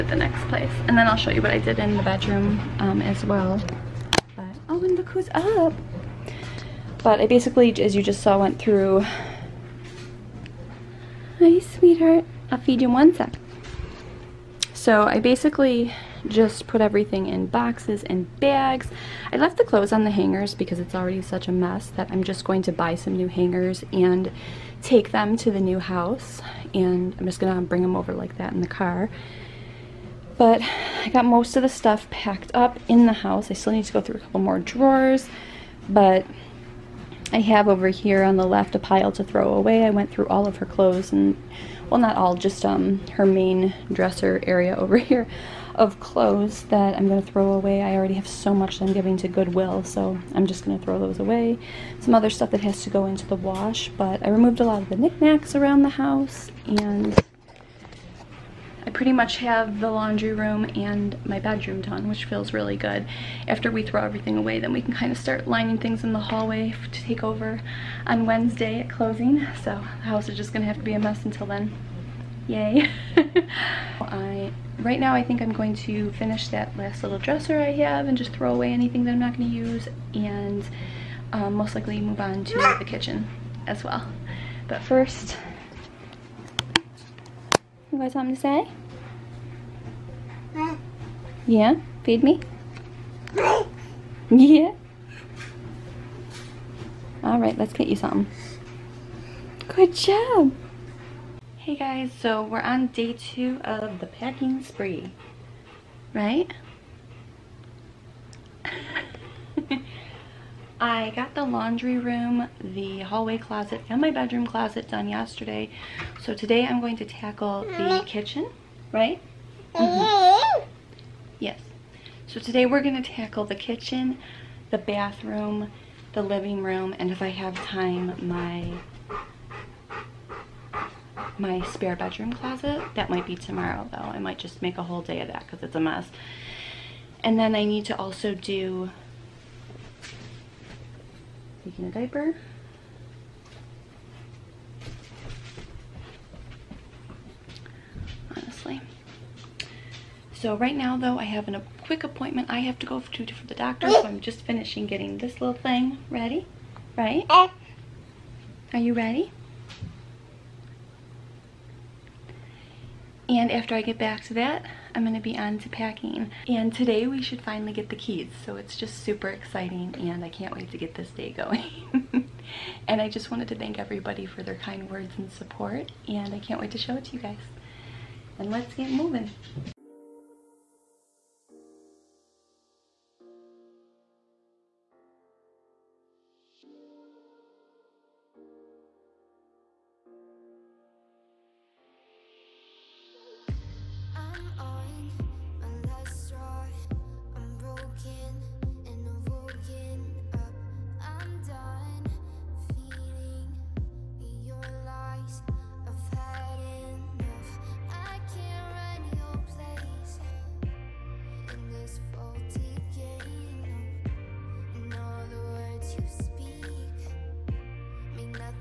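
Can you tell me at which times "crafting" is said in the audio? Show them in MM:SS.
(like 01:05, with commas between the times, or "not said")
not said.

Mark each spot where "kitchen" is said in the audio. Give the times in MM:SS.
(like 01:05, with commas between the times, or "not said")
01:22, 01:58, 02:03.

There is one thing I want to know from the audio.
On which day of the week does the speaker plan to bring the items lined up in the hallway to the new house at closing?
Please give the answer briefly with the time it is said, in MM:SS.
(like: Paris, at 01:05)
Wednesday, at 01:08.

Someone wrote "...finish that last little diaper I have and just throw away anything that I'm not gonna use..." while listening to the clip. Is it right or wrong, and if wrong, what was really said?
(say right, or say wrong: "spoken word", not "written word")
wrong: "dresser", not "diaper".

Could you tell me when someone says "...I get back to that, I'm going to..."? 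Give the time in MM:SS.
02:43.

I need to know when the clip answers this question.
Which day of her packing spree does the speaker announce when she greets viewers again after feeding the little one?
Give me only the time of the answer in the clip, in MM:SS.
01:42.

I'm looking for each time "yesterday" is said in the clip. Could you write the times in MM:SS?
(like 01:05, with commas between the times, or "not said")
01:55.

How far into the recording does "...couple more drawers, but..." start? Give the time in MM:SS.
00:34.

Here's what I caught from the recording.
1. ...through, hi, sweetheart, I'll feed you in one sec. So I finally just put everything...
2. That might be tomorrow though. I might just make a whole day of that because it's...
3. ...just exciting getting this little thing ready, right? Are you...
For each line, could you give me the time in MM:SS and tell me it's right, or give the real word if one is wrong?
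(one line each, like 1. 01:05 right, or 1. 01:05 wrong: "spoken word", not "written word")
1. 00:08 wrong: "basically", not "finally"
2. 02:12 right
3. 02:34 wrong: "finishing", not "exciting".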